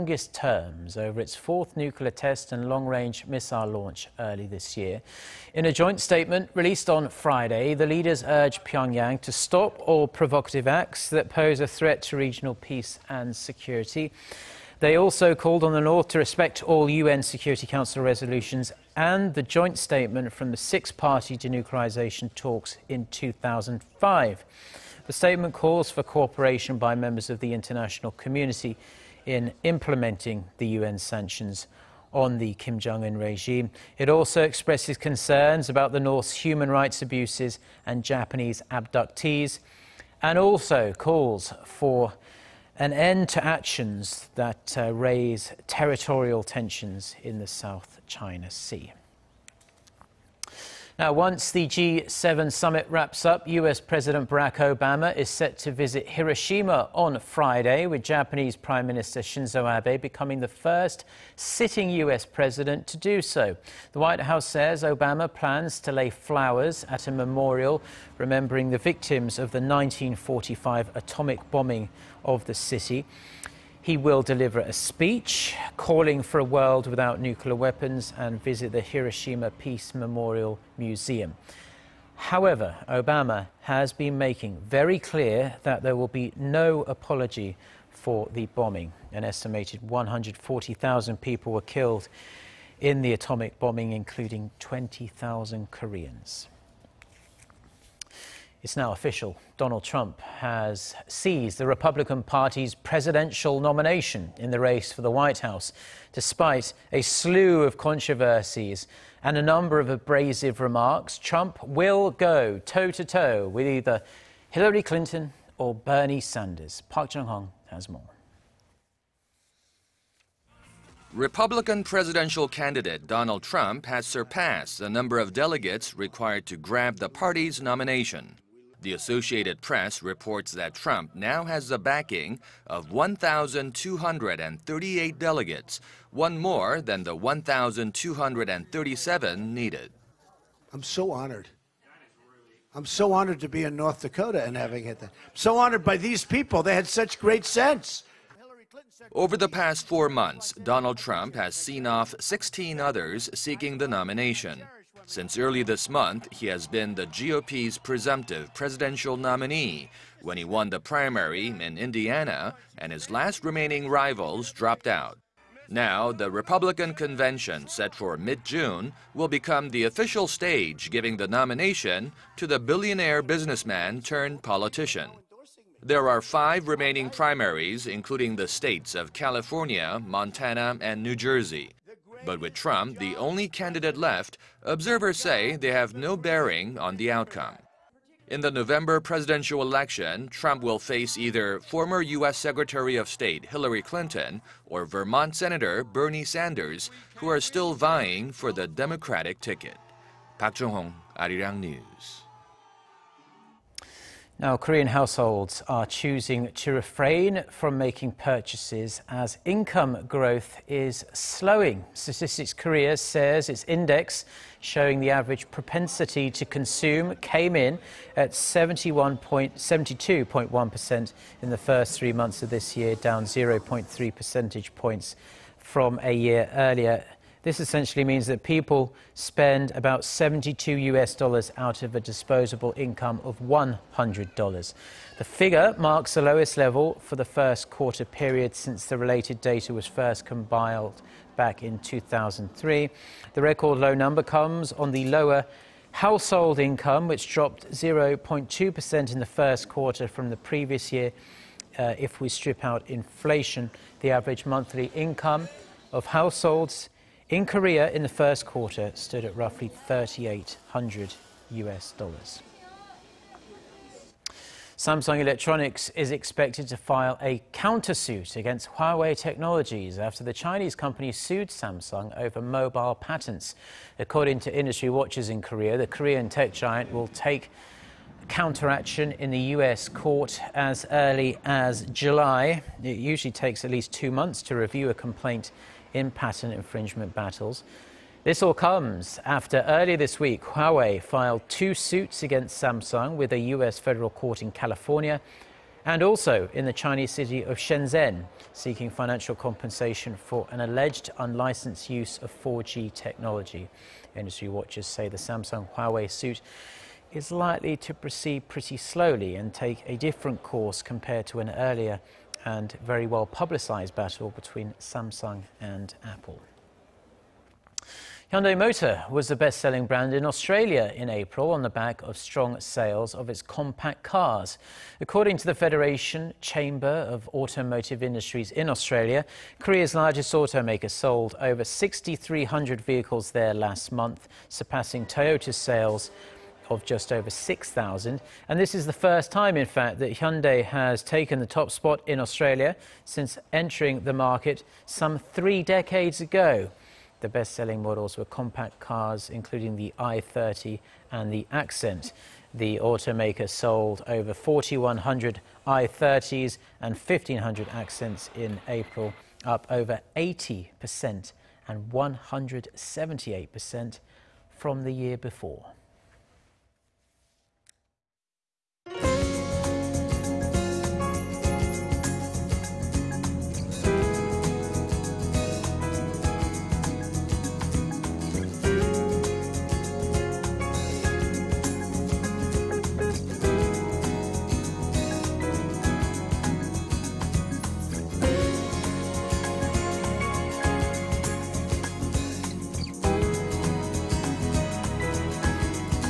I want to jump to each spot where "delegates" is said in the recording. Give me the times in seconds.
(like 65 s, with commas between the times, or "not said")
125 s, 135 s.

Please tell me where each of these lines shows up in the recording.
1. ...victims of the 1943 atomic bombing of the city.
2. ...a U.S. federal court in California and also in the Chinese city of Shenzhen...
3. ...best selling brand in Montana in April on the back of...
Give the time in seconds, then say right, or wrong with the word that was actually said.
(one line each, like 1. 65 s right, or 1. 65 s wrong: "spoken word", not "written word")
1. 68 s wrong: "1945", not "1943"
2. 293 s right
3. 319 s wrong: "Australia", not "Montana".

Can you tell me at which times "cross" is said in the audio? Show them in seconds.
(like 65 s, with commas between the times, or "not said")
not said.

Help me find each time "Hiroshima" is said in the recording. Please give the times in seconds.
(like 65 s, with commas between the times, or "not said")
56 s, 78 s.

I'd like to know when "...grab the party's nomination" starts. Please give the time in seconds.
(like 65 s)
126 s.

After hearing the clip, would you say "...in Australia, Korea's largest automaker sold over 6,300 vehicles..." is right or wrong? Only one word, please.
right.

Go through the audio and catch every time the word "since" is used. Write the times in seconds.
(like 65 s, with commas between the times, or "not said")
155 s, 238 s, 343 s.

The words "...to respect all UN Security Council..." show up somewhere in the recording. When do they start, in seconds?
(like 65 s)
16 s.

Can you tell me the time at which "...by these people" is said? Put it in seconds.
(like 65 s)
145 s.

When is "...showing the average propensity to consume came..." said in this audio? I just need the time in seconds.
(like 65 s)
214 s.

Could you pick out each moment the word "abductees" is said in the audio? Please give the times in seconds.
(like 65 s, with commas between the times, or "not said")
38 s.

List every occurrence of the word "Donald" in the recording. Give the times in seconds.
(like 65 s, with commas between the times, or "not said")
99 s, 123 s, 150 s.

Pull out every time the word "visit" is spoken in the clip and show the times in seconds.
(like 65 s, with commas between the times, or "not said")
55 s, 78 s.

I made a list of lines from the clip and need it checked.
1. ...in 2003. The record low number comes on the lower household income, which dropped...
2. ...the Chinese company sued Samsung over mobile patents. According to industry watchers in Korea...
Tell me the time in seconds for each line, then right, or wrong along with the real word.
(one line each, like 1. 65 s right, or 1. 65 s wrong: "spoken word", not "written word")
1. 241 s right
2. 270 s right.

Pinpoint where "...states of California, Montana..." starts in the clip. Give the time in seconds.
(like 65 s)
178 s.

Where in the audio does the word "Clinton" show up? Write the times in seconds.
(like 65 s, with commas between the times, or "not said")
114 s, 193 s.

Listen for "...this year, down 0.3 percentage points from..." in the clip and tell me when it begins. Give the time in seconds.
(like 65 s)
222 s.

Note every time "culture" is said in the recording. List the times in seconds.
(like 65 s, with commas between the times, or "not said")
not said.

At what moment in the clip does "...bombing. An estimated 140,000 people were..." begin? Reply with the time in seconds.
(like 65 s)
88 s.